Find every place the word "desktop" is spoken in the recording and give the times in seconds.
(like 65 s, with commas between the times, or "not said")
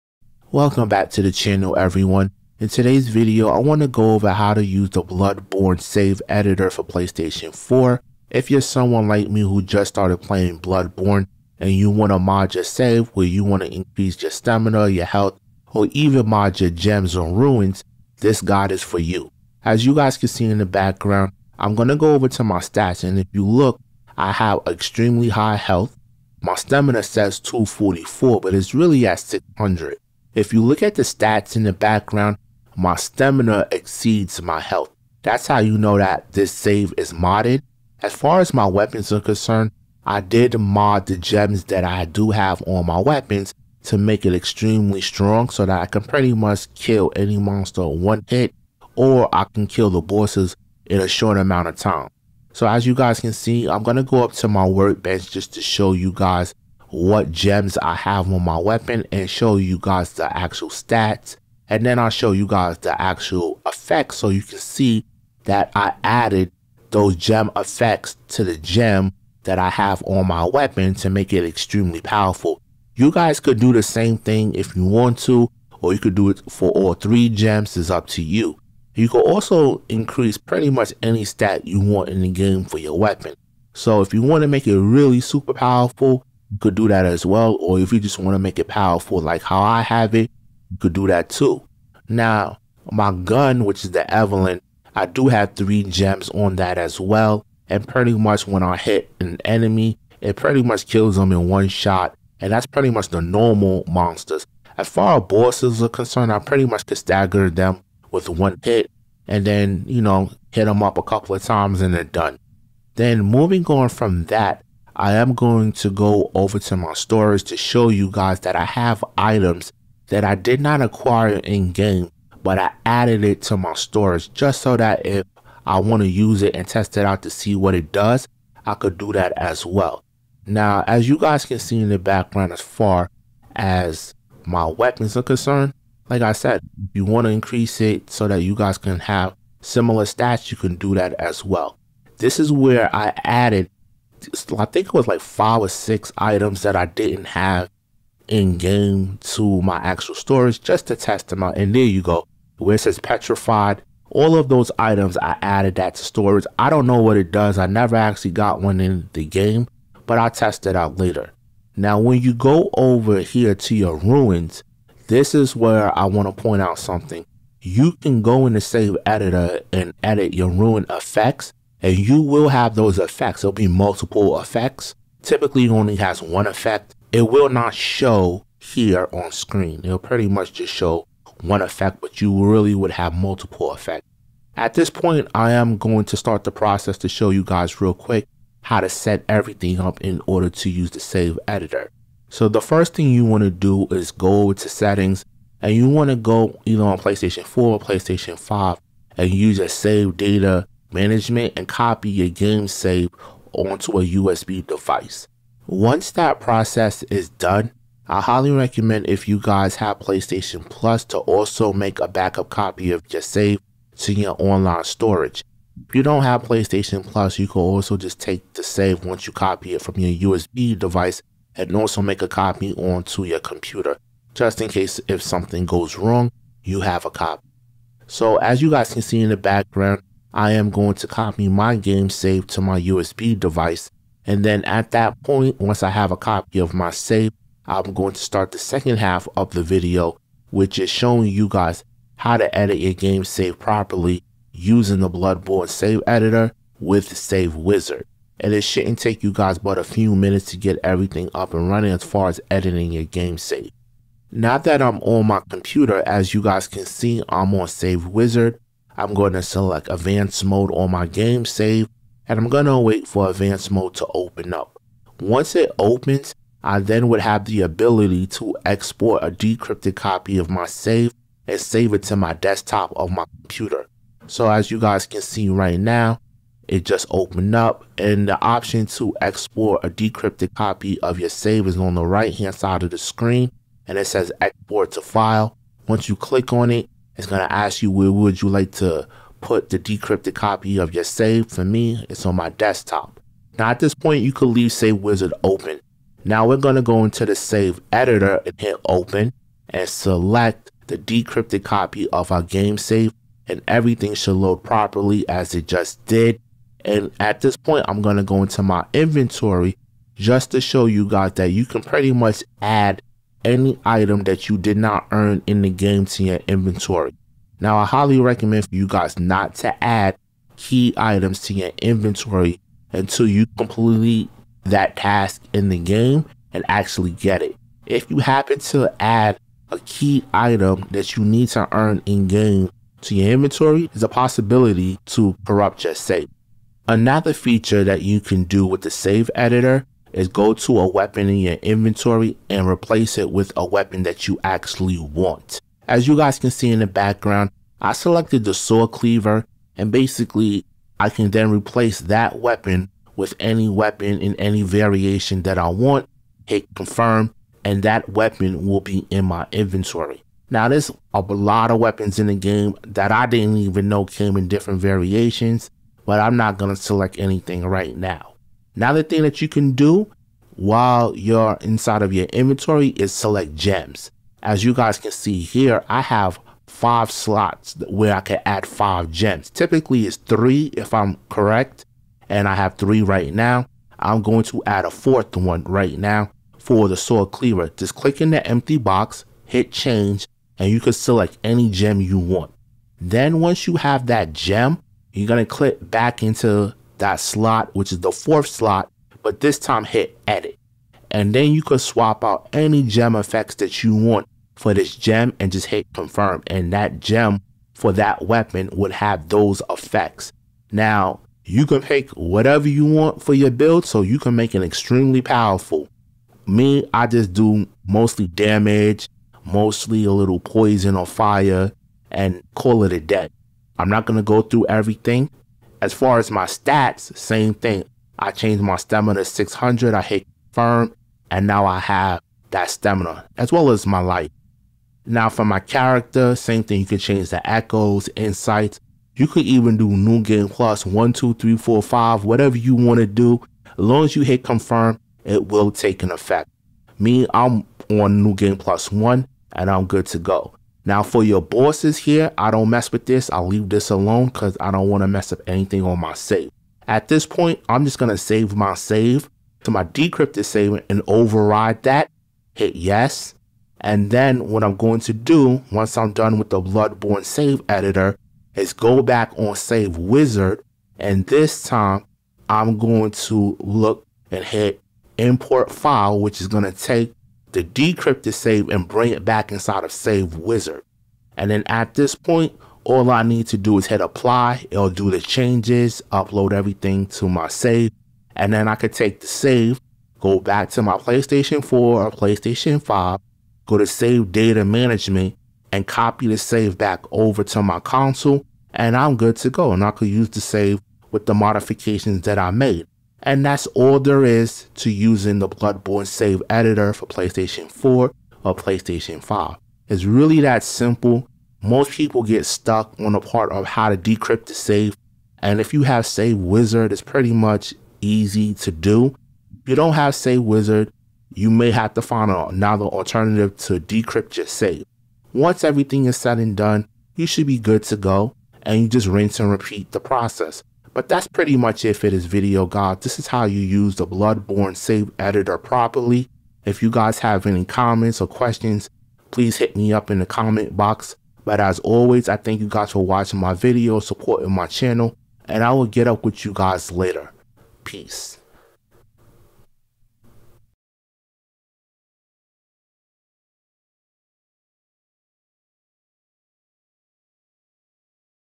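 272 s, 292 s.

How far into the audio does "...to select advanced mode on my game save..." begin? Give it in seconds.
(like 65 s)
259 s.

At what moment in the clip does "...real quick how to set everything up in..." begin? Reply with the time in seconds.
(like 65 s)
187 s.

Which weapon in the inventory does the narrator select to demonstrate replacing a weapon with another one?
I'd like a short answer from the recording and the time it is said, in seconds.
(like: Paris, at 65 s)
saw cleaver, at 348 s.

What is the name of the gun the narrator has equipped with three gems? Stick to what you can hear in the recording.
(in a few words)
Evelyn.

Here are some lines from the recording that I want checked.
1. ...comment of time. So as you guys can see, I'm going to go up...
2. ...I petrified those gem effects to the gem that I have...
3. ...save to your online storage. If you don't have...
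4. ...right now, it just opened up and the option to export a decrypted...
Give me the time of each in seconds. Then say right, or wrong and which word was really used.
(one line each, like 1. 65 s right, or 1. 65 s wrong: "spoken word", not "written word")
1. 51 s wrong: "amount", not "comment"
2. 65 s wrong: "added", not "petrified"
3. 213 s right
4. 275 s right.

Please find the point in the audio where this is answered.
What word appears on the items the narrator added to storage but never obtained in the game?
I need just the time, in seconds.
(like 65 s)
152 s.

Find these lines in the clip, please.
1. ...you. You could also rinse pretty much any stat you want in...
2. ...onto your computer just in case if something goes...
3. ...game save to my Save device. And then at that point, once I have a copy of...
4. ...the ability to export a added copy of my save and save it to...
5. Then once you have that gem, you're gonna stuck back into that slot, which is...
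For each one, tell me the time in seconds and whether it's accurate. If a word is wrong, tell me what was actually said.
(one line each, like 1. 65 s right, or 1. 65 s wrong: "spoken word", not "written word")
1. 78 s wrong: "increase", not "rinse"
2. 222 s right
3. 231 s wrong: "USB", not "Save"
4. 267 s wrong: "decrypted", not "added"
5. 392 s wrong: "click", not "stuck".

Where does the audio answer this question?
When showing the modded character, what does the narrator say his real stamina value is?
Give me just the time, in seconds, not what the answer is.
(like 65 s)
28 s.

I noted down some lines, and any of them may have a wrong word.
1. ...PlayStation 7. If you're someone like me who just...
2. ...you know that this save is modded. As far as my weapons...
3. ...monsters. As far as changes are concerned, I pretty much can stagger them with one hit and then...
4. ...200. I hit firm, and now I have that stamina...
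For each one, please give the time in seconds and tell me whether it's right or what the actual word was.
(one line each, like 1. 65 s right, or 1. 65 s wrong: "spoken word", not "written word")
1. 6 s wrong: "4", not "7"
2. 35 s right
3. 103 s wrong: "bosses", not "changes"
4. 429 s wrong: "600", not "200".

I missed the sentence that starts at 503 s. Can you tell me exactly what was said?
And that's all there is to using the Bloodborne save editor for PlayStation 4 or PlayStation 5.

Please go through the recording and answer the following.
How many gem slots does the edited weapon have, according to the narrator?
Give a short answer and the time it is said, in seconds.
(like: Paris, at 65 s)
5, at 376 s.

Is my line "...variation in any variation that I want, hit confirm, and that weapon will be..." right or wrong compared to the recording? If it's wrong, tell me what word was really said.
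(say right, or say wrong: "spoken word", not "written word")
wrong: "weapon", not "variation".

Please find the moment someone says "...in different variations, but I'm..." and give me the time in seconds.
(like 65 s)
364 s.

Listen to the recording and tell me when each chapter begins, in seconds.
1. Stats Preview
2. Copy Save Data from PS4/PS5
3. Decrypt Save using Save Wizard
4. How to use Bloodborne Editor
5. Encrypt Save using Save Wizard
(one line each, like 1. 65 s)
1. 23 s
2. 210 s
3. 260 s
4. 300 s
5. 485 s.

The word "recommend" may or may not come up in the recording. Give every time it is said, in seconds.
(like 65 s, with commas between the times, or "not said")
208 s, 318 s.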